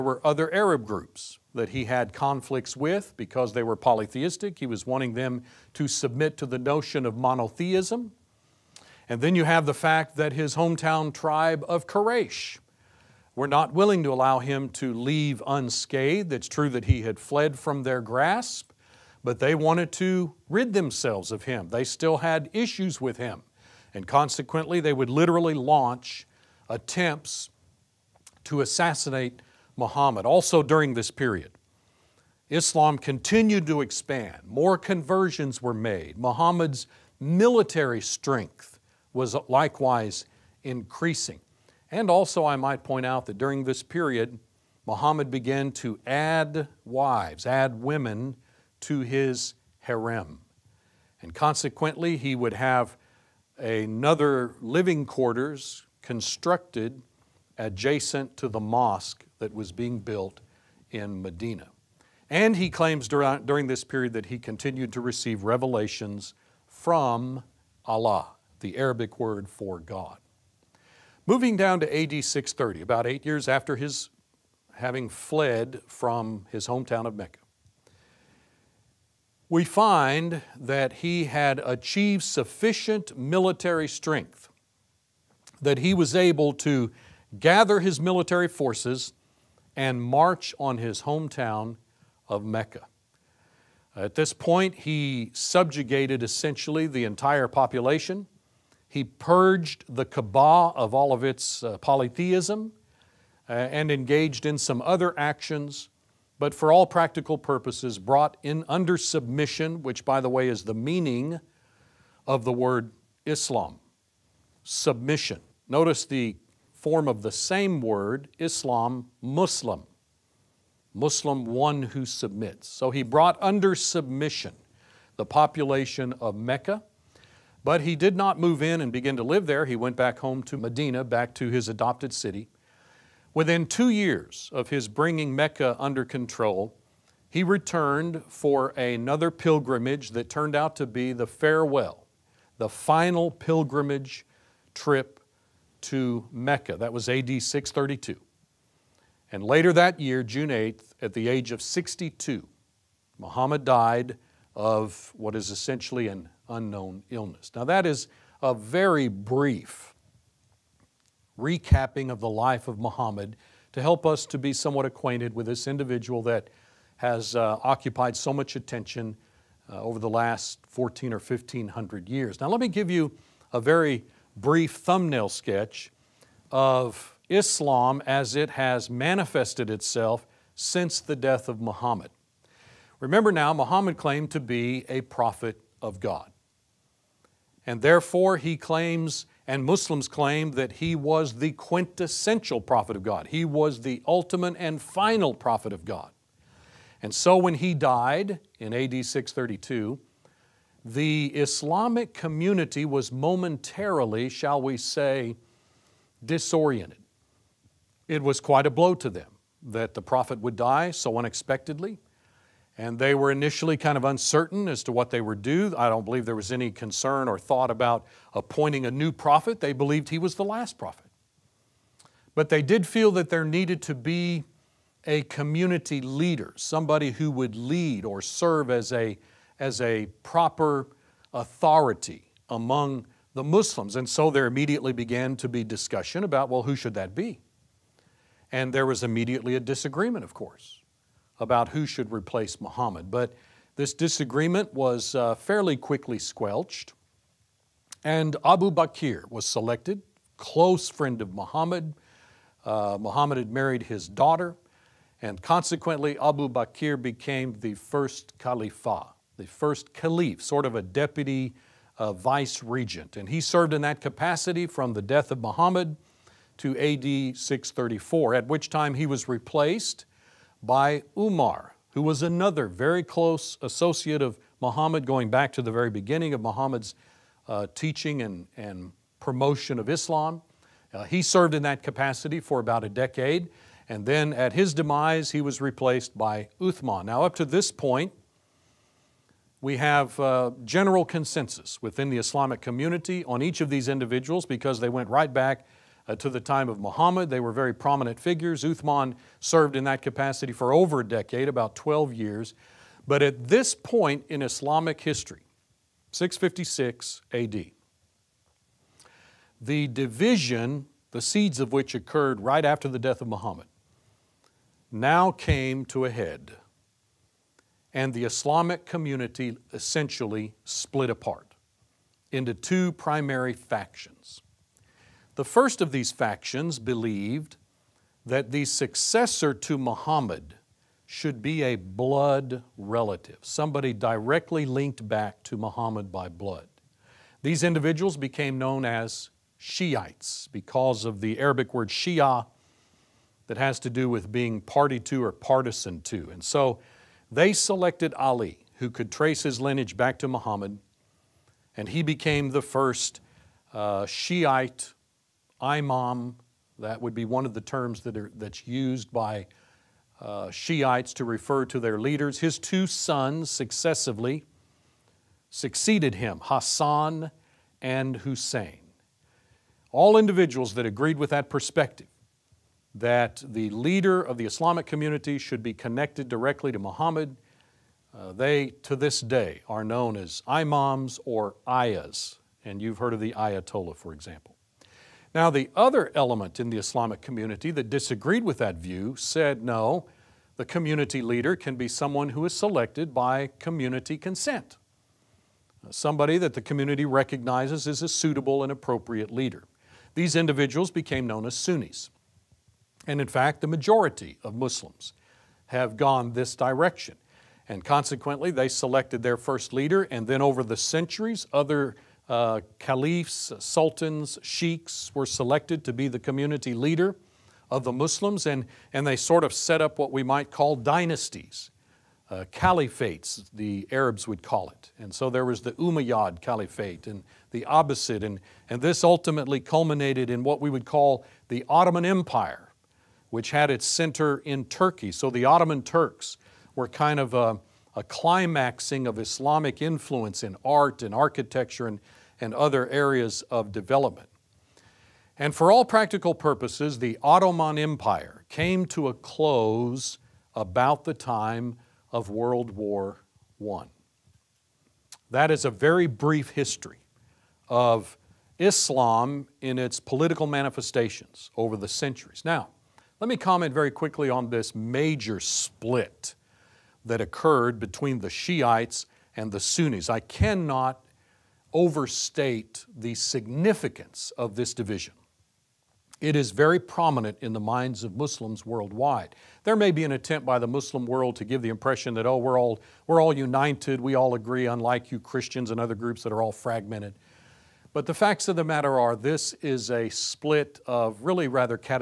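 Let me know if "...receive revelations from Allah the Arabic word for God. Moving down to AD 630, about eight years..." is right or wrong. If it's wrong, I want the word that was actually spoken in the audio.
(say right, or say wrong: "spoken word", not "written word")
right.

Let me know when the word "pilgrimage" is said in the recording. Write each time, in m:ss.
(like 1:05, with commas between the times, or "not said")
2:19, 2:23.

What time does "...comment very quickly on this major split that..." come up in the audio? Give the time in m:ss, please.
7:43.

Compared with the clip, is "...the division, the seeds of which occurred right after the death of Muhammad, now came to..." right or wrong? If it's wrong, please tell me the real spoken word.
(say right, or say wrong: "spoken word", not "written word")
right.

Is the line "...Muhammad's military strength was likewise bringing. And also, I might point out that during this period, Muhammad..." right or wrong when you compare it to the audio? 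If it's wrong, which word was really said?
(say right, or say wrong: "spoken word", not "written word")
wrong: "increasing", not "bringing".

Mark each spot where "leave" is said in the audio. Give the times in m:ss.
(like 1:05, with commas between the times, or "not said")
0:14.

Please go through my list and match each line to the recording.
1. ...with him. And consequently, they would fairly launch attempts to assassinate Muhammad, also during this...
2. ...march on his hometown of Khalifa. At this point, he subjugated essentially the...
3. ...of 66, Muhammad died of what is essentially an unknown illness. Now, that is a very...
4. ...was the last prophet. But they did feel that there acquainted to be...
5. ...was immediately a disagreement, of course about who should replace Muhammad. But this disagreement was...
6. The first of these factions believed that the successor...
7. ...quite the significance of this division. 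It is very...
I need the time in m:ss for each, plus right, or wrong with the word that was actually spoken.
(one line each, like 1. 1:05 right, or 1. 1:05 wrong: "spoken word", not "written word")
1. 0:22 wrong: "literally", not "fairly"
2. 1:30 wrong: "Mecca", not "Khalifa"
3. 2:31 wrong: "62", not "66"
4. 3:40 wrong: "needed", not "acquainted"
5. 3:58 right
6. 5:25 right
7. 7:51 wrong: "overstate", not "quite".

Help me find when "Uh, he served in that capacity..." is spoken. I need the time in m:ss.
4:40.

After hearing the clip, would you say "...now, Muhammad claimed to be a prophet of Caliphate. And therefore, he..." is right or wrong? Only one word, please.
wrong.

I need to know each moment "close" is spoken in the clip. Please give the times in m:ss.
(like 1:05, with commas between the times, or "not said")
4:10, 4:33, 7:29.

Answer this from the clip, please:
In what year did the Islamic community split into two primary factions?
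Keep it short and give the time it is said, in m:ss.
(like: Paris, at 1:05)
656, at 5:06.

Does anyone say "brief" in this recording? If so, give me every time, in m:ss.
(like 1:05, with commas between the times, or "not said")
2:39, 2:54, 7:36.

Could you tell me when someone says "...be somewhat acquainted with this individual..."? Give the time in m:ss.
2:44.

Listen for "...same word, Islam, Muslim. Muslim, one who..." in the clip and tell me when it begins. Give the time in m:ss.
1:57.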